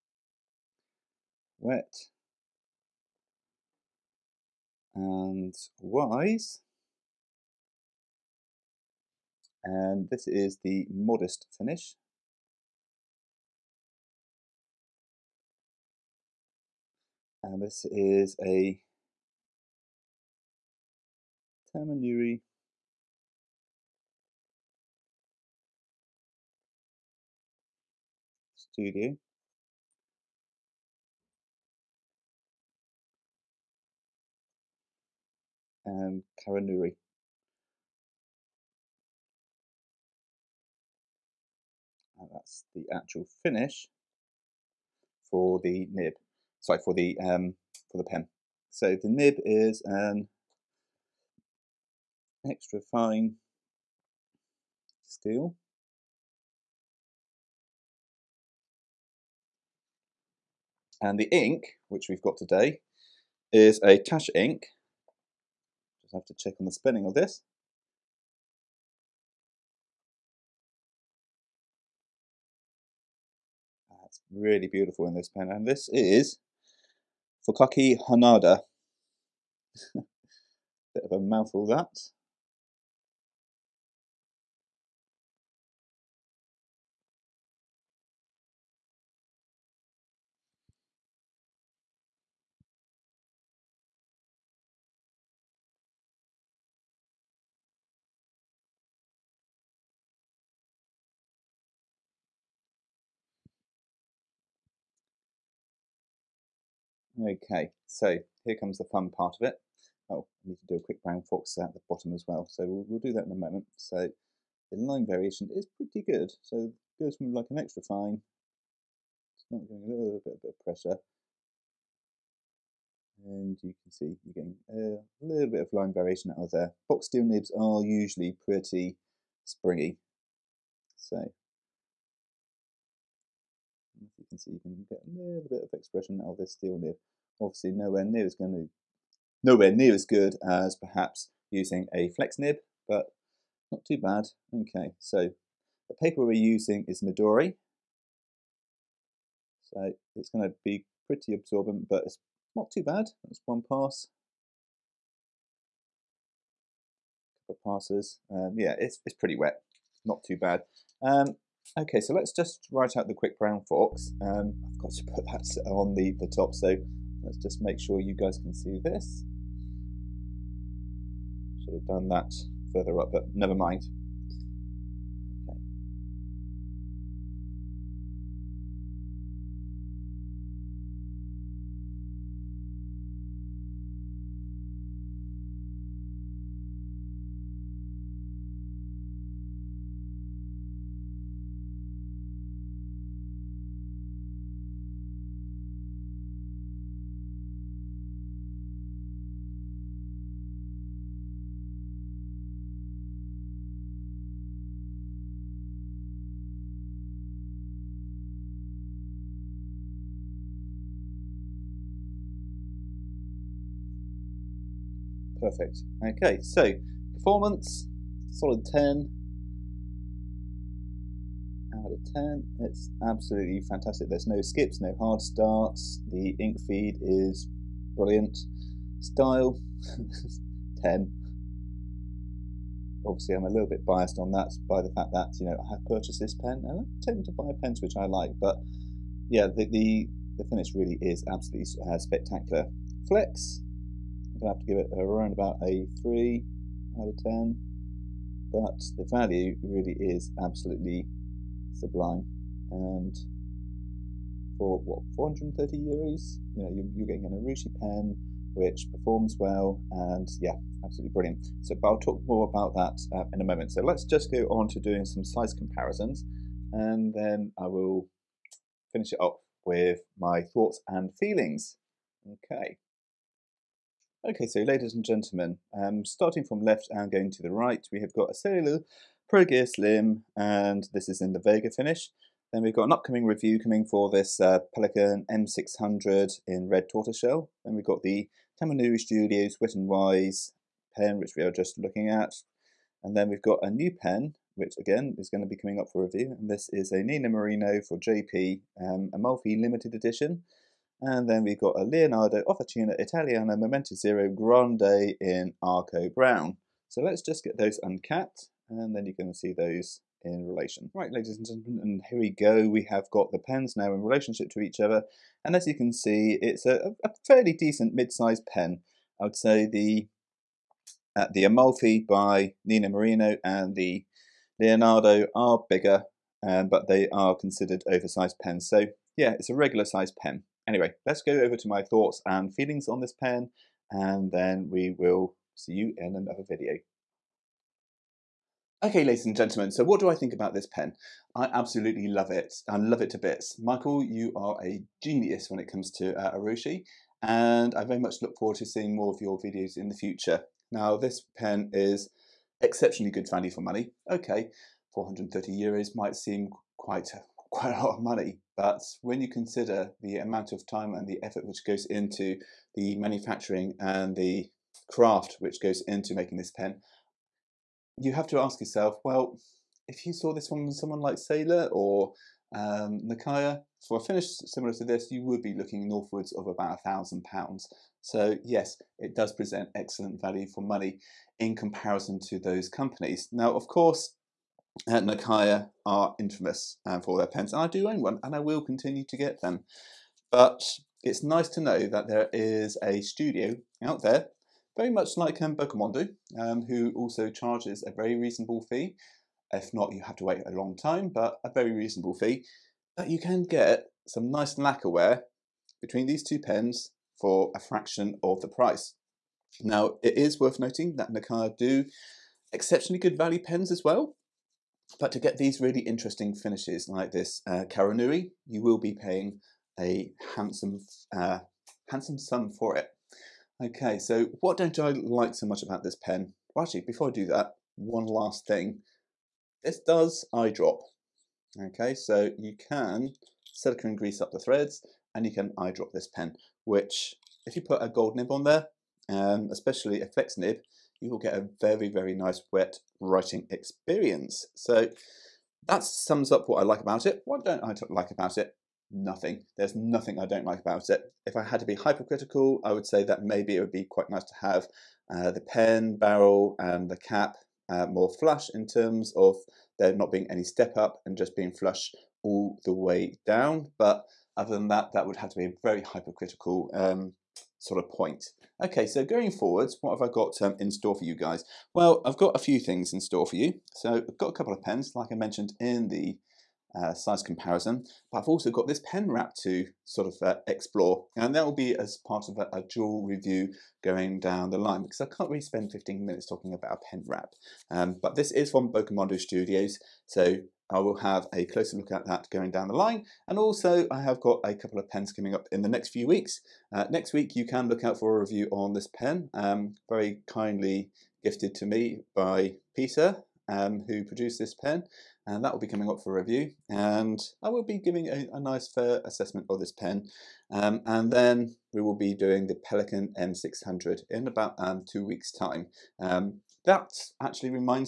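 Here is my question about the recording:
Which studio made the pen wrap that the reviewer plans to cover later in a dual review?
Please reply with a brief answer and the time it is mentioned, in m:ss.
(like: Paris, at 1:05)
Bokumondo Studios, at 8:08.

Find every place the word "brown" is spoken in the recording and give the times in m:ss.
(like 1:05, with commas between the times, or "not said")
1:51, 2:43, 5:06.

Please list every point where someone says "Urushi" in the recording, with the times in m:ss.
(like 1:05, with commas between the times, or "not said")
4:17, 5:46.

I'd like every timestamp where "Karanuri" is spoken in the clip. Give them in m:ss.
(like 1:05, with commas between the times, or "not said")
0:36, 6:57.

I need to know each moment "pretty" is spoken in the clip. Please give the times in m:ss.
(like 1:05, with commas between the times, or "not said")
1:55, 2:08, 2:31, 2:39.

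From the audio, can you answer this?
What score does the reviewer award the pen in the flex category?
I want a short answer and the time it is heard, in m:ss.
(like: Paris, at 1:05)
3 out of 10, at 4:05.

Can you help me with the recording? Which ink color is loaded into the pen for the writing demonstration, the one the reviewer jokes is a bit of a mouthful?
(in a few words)
Fukaki Hanada.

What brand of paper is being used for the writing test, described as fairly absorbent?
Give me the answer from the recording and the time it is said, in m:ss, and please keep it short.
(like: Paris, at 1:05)
Midori, at 2:27.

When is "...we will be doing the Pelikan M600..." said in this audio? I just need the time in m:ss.
8:31.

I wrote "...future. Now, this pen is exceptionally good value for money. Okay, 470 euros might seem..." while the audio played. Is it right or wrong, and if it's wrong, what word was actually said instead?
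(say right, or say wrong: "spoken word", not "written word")
wrong: "430", not "470".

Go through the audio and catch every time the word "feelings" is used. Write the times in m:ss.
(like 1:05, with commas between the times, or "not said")
4:31, 5:32.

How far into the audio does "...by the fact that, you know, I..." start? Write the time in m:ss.
3:54.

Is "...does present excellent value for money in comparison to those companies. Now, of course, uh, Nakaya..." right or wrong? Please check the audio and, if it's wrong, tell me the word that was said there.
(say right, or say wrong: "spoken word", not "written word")
right.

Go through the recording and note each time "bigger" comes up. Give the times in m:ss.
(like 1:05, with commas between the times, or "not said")
5:25.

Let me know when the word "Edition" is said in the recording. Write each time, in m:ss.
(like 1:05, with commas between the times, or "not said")
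4:59.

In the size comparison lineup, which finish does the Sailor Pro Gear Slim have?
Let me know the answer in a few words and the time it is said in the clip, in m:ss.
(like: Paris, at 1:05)
Vega, at 4:41.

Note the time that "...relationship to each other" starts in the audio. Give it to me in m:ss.
5:14.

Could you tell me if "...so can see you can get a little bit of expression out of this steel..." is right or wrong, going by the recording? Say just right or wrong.
right.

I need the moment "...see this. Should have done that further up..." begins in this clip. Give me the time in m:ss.
2:48.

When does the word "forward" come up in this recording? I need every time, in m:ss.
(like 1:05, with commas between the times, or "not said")
5:48, 7:49.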